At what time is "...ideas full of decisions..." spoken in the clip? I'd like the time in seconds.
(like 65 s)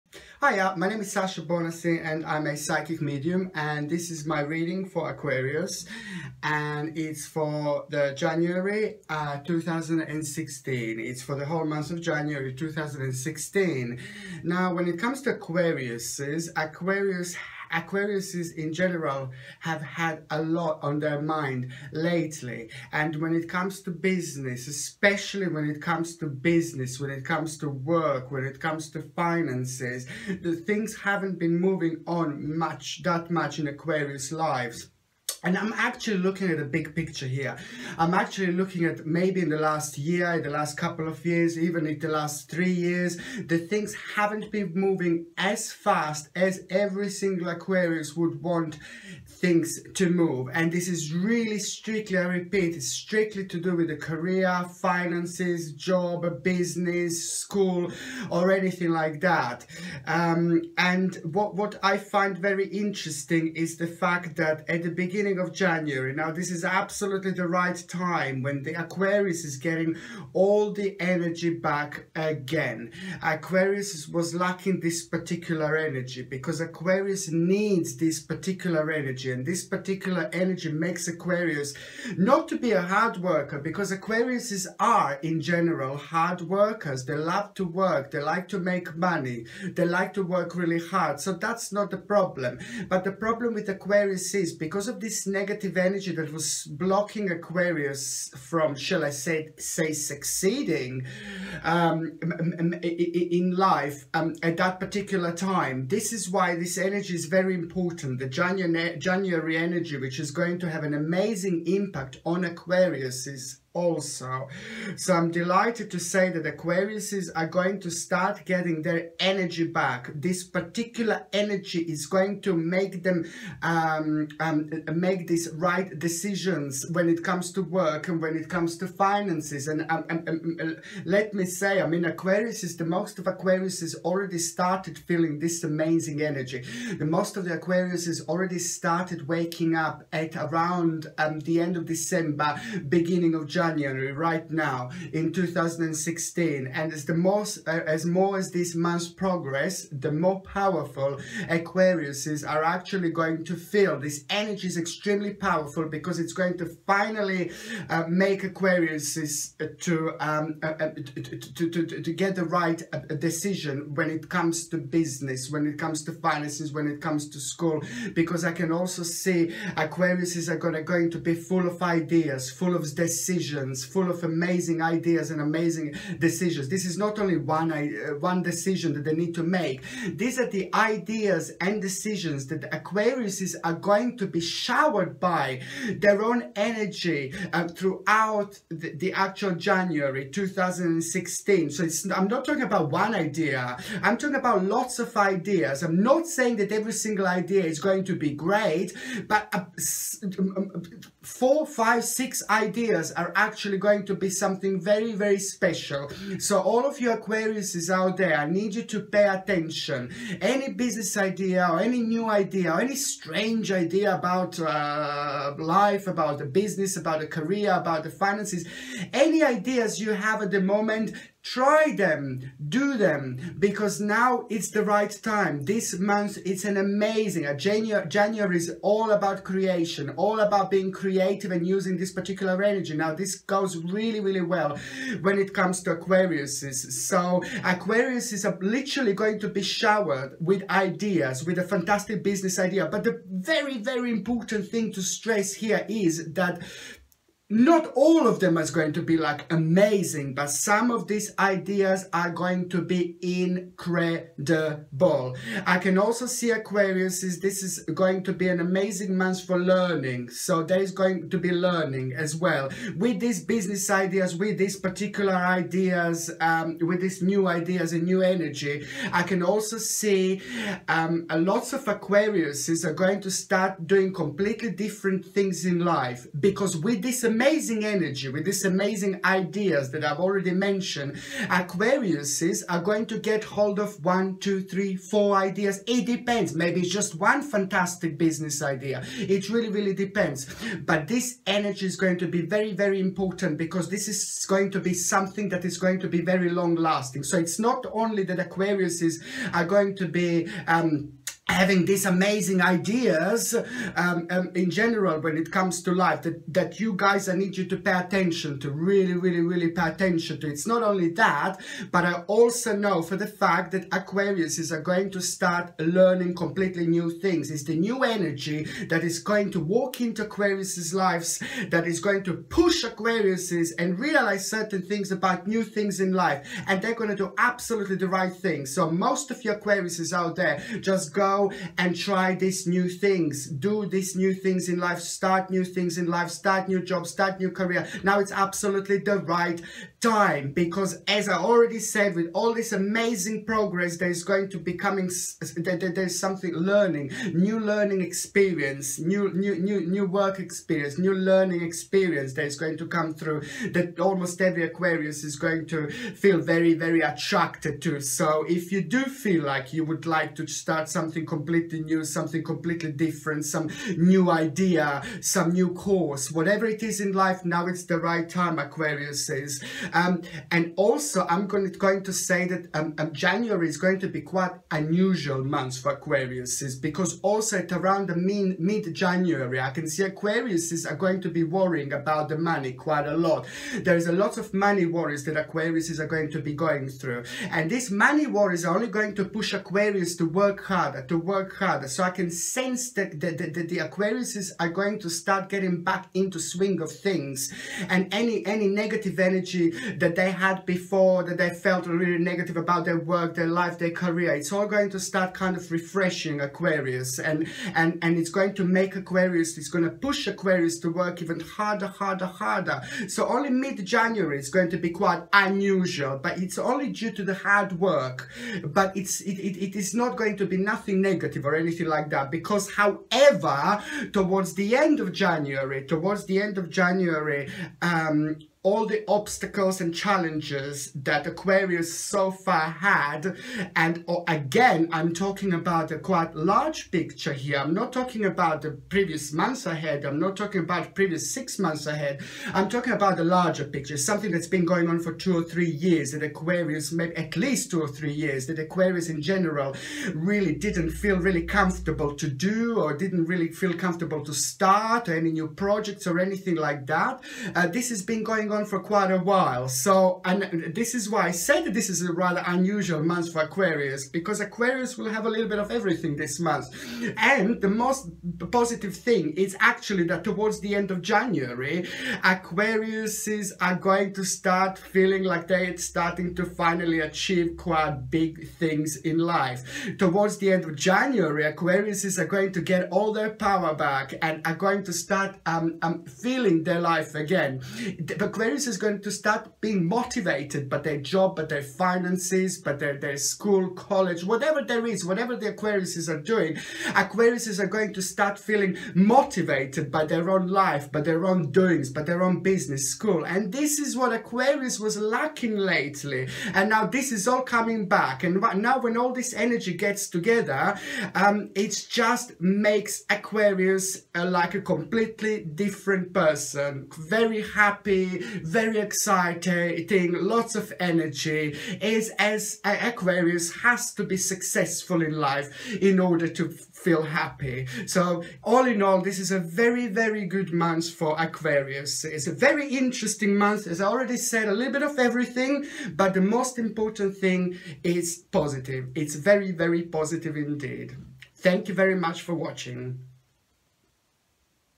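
171 s.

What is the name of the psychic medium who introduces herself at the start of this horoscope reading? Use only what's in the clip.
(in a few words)
Sasha Bonasin.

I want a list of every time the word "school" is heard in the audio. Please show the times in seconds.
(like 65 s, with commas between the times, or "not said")
57 s, 167 s, 493 s, 502 s.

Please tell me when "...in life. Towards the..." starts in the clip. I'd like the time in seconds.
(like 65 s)
478 s.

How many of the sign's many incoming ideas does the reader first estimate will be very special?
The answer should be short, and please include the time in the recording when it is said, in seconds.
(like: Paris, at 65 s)
4, 5, 6, at 201 s.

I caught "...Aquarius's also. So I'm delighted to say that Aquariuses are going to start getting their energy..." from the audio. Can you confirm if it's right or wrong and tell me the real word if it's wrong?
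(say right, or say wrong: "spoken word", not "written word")
right.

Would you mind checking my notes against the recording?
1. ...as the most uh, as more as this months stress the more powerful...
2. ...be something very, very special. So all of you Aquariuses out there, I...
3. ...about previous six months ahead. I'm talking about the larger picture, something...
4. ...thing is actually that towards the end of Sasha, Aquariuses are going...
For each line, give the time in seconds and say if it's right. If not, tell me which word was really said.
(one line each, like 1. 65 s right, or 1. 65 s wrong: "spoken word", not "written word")
1. 146 s wrong: "progress", not "stress"
2. 204 s right
3. 440 s right
4. 468 s wrong: "January", not "Sasha".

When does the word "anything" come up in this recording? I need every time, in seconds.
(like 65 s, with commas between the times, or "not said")
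58 s, 421 s, 456 s.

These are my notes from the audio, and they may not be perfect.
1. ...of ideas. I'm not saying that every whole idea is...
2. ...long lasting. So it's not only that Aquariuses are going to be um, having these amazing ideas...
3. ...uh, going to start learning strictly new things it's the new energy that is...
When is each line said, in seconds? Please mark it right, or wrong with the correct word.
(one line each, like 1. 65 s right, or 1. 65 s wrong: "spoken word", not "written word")
1. 194 s wrong: "single", not "whole"
2. 296 s right
3. 314 s wrong: "completely", not "strictly".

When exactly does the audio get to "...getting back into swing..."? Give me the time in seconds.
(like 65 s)
395 s.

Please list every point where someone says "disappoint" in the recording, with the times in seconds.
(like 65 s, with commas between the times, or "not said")
not said.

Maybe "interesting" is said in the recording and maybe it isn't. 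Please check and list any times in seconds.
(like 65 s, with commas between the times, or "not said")
62 s, 532 s.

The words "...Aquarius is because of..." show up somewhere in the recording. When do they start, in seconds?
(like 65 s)
93 s.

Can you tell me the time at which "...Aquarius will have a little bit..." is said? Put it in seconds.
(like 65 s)
464 s.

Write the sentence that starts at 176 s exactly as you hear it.
This is not only one, uh, one decision that they need to make.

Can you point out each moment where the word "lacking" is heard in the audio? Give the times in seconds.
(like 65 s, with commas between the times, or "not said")
74 s, 504 s.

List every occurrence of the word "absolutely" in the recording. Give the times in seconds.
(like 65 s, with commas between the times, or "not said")
66 s, 327 s, 338 s.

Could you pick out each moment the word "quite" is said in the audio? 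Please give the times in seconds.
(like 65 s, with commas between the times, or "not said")
374 s, 382 s, 414 s, 435 s, 458 s, 477 s.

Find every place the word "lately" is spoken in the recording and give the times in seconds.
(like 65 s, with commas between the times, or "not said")
21 s, 505 s.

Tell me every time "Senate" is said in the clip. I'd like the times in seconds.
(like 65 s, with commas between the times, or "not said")
not said.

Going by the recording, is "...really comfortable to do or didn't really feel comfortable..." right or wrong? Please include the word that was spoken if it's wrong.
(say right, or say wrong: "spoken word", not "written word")
right.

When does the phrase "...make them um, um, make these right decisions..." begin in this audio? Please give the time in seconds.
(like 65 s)
122 s.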